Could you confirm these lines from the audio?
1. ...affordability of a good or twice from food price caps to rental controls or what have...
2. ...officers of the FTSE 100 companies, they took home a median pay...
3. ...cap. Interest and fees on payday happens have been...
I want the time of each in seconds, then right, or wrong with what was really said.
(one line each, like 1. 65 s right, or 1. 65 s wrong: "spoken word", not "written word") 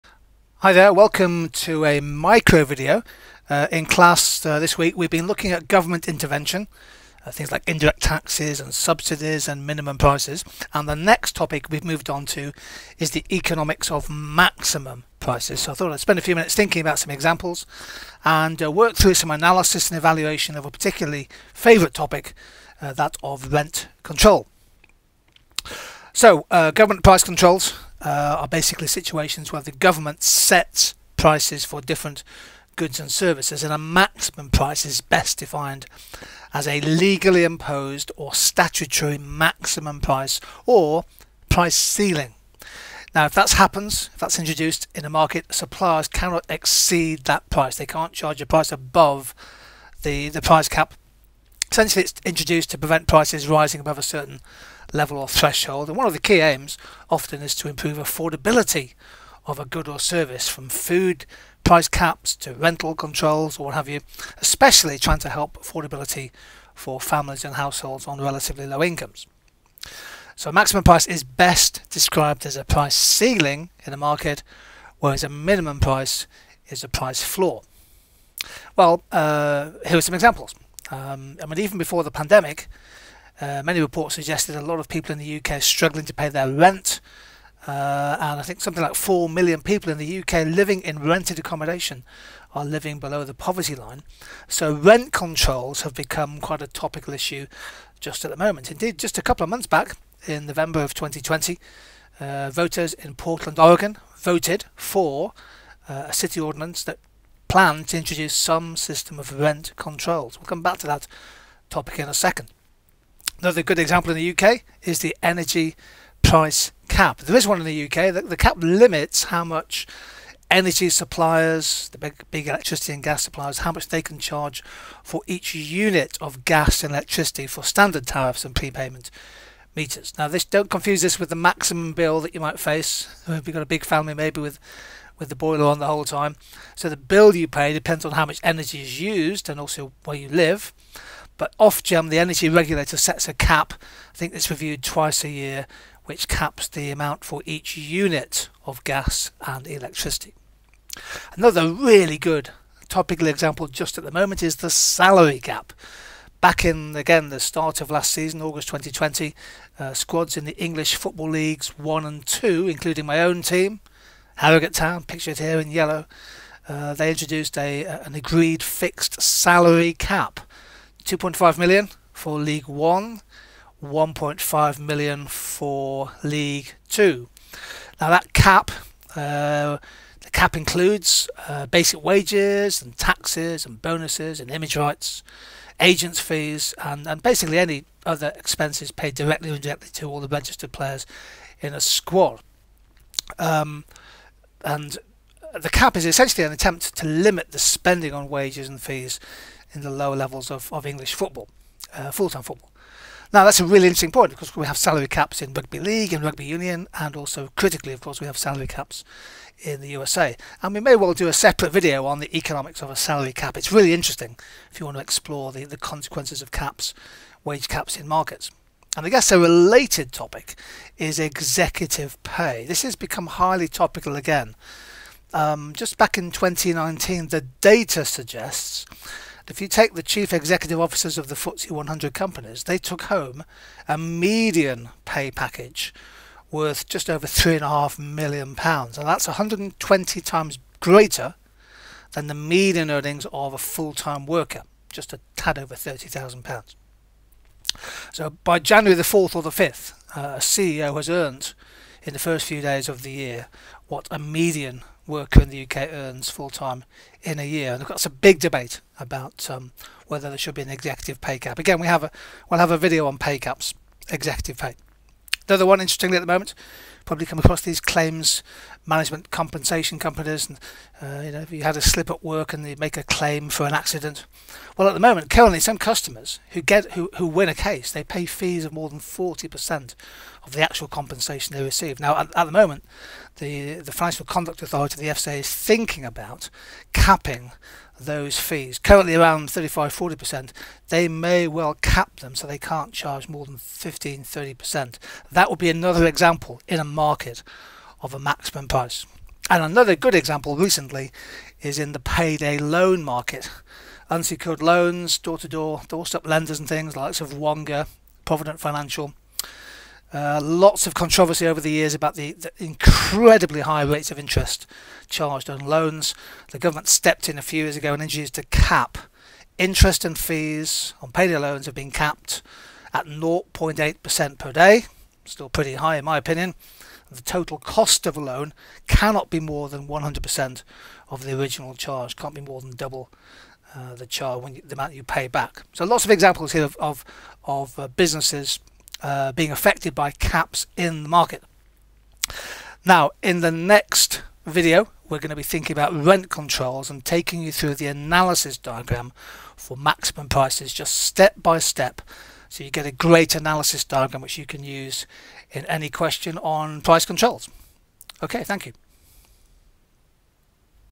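1. 57 s wrong: "service", not "twice"
2. 230 s right
3. 318 s wrong: "loans", not "happens".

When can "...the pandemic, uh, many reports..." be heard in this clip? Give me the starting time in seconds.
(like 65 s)
82 s.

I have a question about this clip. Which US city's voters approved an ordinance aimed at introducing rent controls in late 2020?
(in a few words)
Portland, Oregon.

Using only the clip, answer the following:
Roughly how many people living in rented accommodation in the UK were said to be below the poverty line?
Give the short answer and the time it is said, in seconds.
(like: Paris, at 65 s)
4 million, at 88 s.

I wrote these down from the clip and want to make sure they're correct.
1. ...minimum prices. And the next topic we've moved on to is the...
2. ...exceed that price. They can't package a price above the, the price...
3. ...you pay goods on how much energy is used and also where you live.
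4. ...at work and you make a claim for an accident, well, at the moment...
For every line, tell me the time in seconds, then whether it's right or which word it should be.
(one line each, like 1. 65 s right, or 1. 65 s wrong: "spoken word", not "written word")
1. 9 s right
2. 46 s wrong: "charge", not "package"
3. 137 s wrong: "depends", not "goods"
4. 272 s right.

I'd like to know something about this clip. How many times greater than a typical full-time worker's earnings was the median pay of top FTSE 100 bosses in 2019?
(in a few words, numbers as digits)
120.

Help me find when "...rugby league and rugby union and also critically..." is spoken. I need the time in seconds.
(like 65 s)
205 s.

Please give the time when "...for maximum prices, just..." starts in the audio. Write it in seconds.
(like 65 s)
349 s.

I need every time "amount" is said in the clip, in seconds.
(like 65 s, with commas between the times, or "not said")
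146 s, 334 s.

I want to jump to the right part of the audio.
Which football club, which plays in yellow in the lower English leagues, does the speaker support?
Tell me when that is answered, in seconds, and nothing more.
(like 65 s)
164 s.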